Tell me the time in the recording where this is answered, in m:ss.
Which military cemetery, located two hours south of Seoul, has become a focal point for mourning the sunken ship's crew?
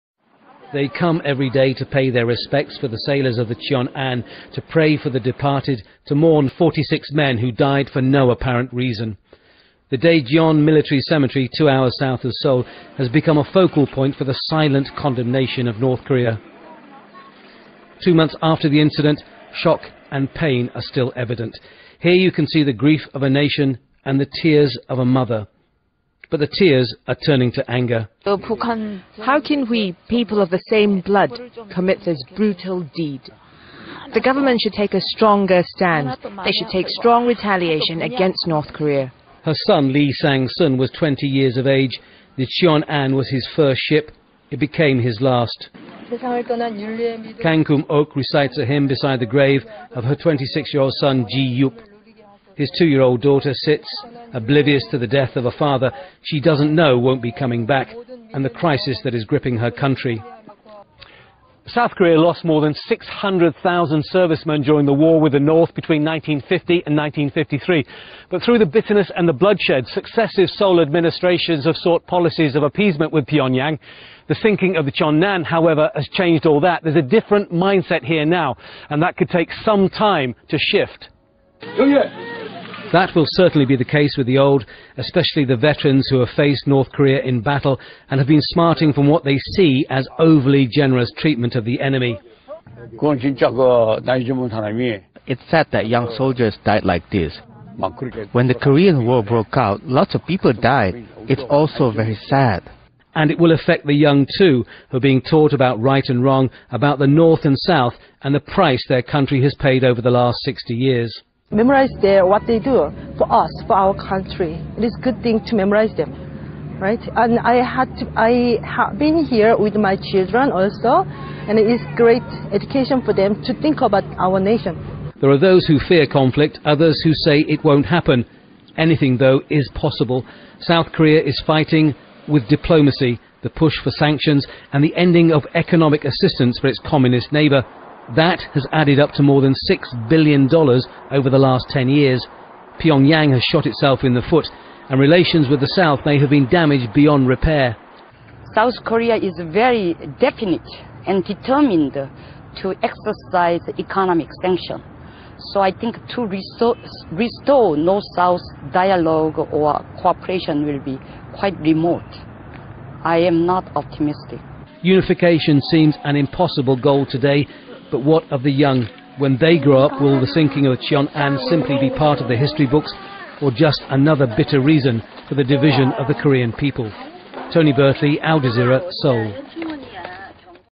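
0:09.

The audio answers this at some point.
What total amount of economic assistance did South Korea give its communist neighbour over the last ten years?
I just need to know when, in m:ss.
2:19.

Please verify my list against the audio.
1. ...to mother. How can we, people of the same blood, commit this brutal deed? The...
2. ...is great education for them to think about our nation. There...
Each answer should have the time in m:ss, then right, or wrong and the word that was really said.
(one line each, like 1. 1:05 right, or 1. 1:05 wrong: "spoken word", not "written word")
1. 0:27 wrong: "anger", not "mother"
2. 2:01 right.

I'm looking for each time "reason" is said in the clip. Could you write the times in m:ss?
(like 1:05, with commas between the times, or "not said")
0:08, 2:54.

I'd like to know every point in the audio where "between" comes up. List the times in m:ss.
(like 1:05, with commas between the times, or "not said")
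1:05.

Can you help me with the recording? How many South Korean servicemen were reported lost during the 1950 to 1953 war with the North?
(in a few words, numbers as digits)
more than 600,000.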